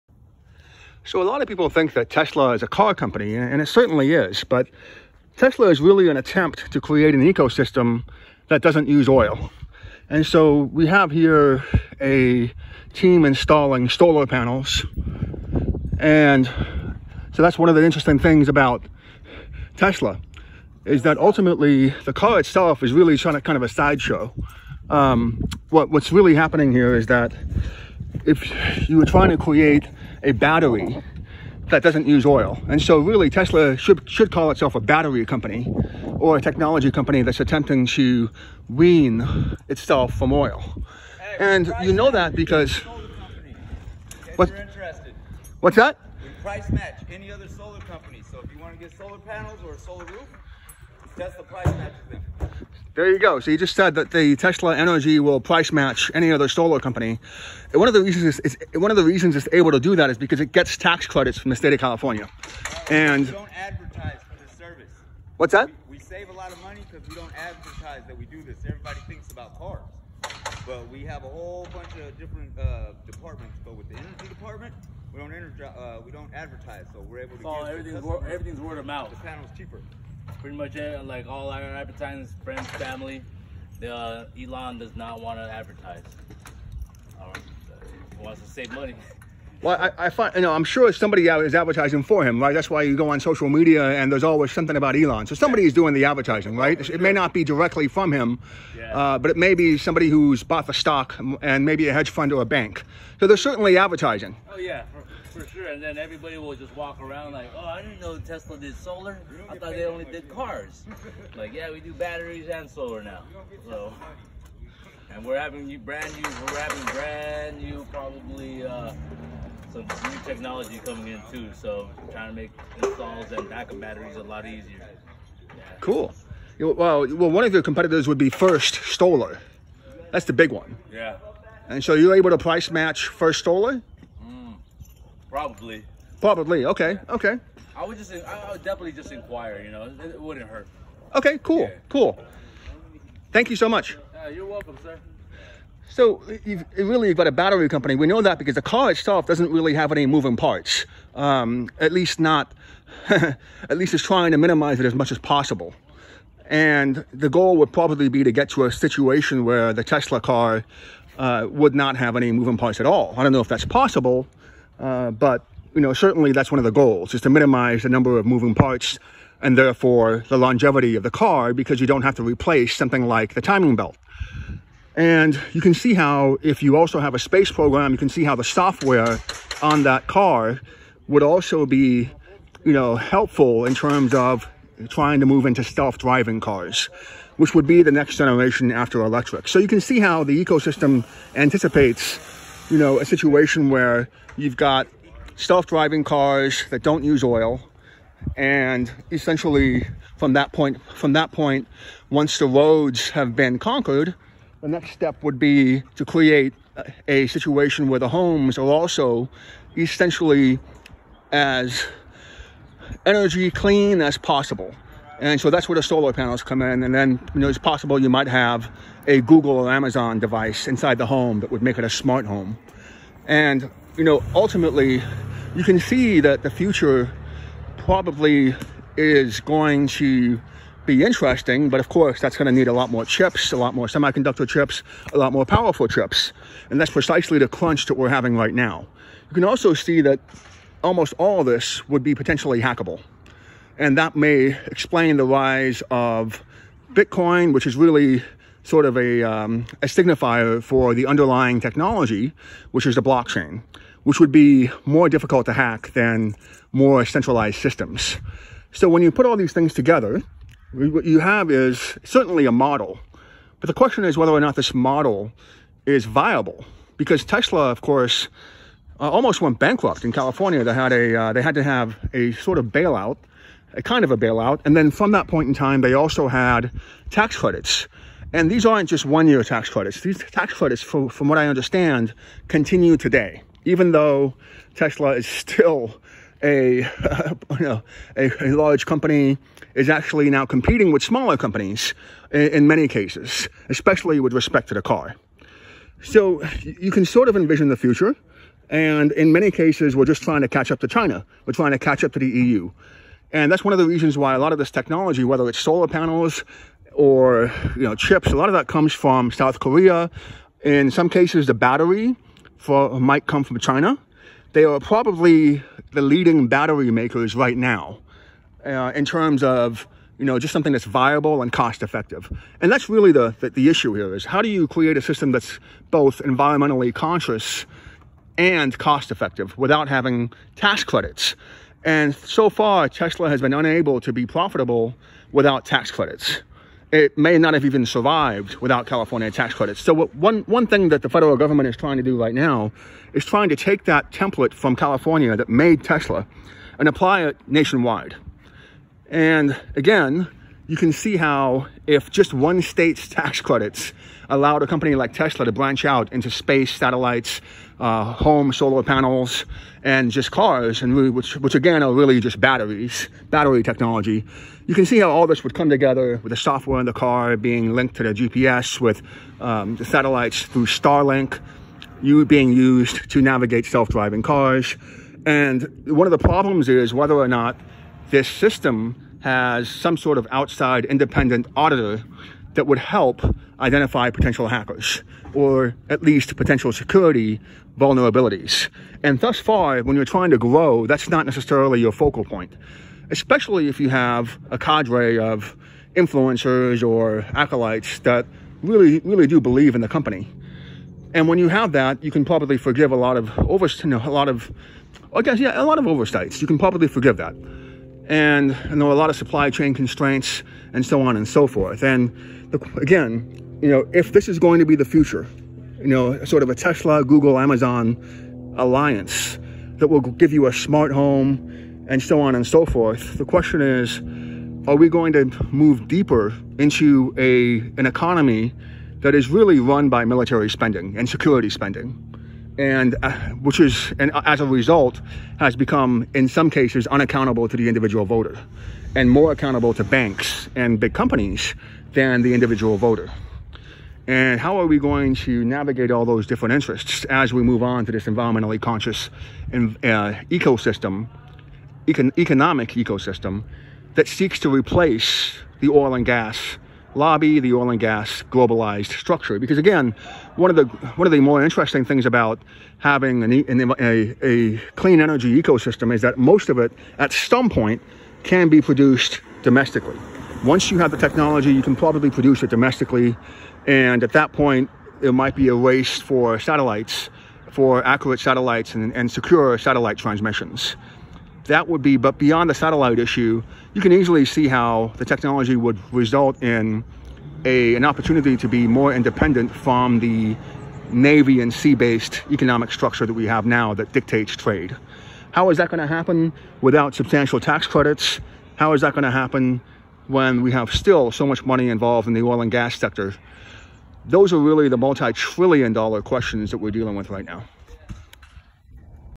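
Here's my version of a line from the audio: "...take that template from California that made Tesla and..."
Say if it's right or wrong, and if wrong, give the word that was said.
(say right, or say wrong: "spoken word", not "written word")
right.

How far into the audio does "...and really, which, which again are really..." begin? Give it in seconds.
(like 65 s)
360 s.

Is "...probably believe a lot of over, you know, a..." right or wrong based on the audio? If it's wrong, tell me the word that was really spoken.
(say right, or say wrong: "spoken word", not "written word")
wrong: "forgive", not "believe".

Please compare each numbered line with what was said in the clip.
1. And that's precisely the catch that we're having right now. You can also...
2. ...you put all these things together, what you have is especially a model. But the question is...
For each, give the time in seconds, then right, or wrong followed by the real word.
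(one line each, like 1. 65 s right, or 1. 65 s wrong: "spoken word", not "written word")
1. 236 s wrong: "crunch", not "catch"
2. 259 s wrong: "certainly", not "especially".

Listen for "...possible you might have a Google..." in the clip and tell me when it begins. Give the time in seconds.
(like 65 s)
217 s.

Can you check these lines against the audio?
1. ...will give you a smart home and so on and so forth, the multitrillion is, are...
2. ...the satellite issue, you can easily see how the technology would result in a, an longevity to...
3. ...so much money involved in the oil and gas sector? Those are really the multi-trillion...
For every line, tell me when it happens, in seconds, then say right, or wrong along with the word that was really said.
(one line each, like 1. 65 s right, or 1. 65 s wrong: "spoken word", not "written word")
1. 419 s wrong: "question", not "multitrillion"
2. 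482 s wrong: "opportunity", not "longevity"
3. 501 s right.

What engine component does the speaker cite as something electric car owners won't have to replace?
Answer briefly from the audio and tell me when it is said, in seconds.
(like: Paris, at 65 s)
Timing belt, at 173 s.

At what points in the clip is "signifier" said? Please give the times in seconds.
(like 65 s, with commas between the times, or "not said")
249 s.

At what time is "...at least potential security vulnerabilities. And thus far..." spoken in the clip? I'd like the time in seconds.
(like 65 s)
385 s.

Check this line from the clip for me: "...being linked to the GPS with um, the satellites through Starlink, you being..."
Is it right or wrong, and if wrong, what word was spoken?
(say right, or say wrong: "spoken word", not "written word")
right.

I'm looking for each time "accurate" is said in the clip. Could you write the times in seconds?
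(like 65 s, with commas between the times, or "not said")
477 s.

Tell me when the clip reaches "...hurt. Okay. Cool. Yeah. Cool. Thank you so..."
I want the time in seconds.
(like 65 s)
140 s.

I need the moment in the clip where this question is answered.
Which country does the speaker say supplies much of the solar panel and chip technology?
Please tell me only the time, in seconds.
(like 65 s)
309 s.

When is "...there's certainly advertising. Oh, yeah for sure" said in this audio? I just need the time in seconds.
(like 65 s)
103 s.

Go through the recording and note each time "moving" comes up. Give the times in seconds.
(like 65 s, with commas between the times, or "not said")
150 s, 162 s, 168 s.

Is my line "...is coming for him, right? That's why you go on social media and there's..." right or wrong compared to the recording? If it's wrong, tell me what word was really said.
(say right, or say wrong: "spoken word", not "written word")
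wrong: "advertising", not "coming".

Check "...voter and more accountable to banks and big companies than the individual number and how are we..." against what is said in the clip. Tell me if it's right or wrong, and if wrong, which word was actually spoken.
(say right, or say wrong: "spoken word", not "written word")
wrong: "voter", not "number".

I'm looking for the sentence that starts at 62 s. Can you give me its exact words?
and we don't advertise for this service.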